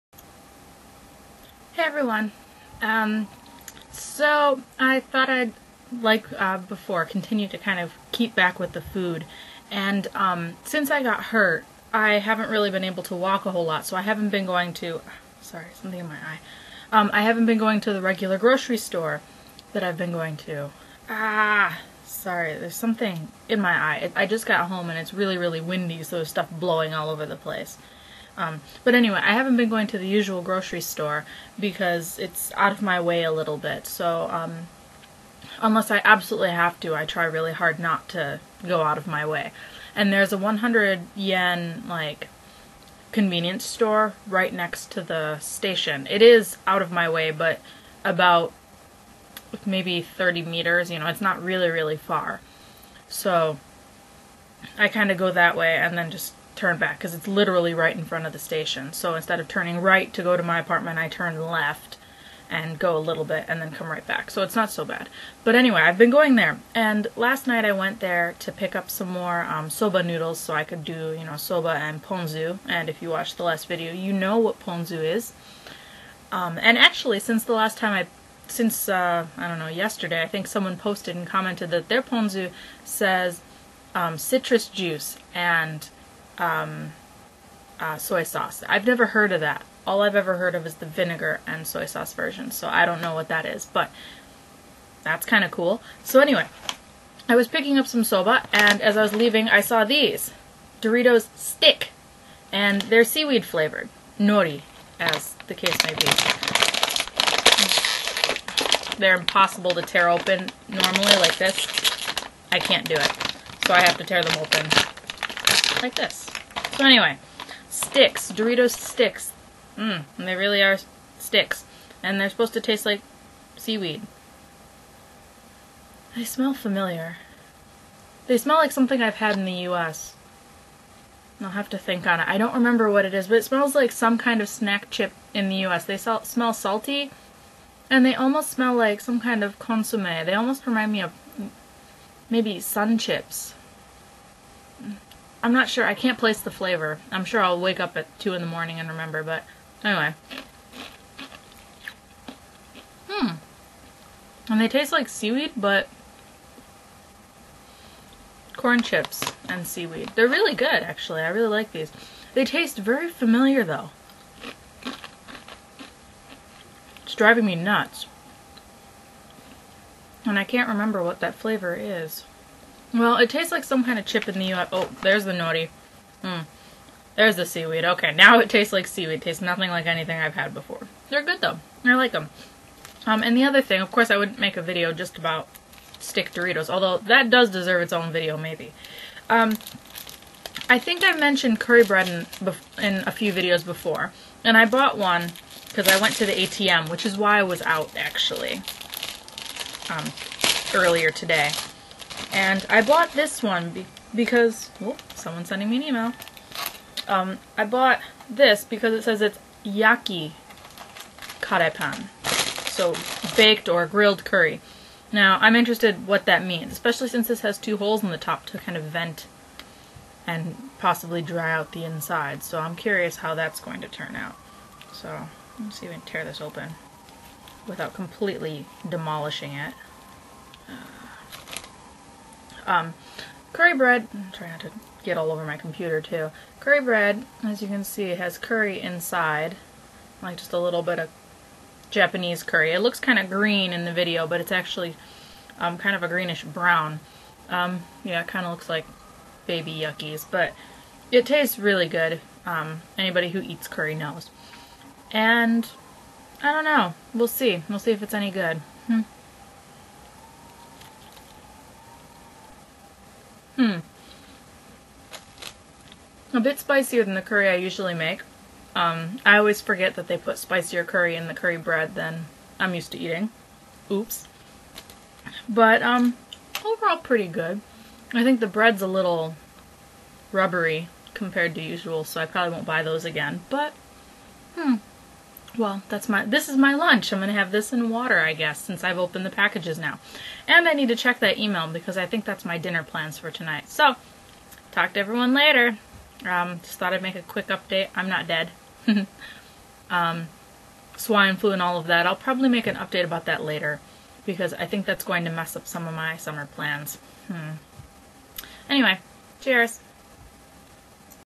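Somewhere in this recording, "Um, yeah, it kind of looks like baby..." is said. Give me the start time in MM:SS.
04:07.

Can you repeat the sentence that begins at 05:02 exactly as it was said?
I'll probably make an update about that later because I think that's going to mess up some of my summer plans.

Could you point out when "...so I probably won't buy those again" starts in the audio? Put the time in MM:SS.
04:42.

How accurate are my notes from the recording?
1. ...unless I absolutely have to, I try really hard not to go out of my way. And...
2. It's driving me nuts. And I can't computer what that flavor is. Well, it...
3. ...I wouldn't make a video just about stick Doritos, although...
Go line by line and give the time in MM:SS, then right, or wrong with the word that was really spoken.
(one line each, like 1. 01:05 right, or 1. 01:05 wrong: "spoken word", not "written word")
1. 00:35 right
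2. 02:47 wrong: "remember", not "computer"
3. 03:04 right.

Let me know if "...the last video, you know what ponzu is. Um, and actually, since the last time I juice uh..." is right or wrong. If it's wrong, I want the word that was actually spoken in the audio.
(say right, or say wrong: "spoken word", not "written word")
wrong: "since", not "juice".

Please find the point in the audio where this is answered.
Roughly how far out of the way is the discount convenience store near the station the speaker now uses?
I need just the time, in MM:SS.
00:50.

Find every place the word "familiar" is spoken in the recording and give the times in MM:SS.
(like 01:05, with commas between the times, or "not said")
02:06, 02:43.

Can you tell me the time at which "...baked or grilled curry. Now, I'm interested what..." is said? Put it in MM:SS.
03:33.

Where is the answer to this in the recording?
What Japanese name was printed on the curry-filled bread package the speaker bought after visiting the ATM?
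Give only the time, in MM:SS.
03:29.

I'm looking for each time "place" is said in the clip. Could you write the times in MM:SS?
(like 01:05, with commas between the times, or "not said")
00:27, 02:26.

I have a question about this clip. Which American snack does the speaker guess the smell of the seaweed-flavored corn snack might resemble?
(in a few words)
Sun Chips.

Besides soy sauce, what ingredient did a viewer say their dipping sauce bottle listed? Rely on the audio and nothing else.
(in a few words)
citrus juice.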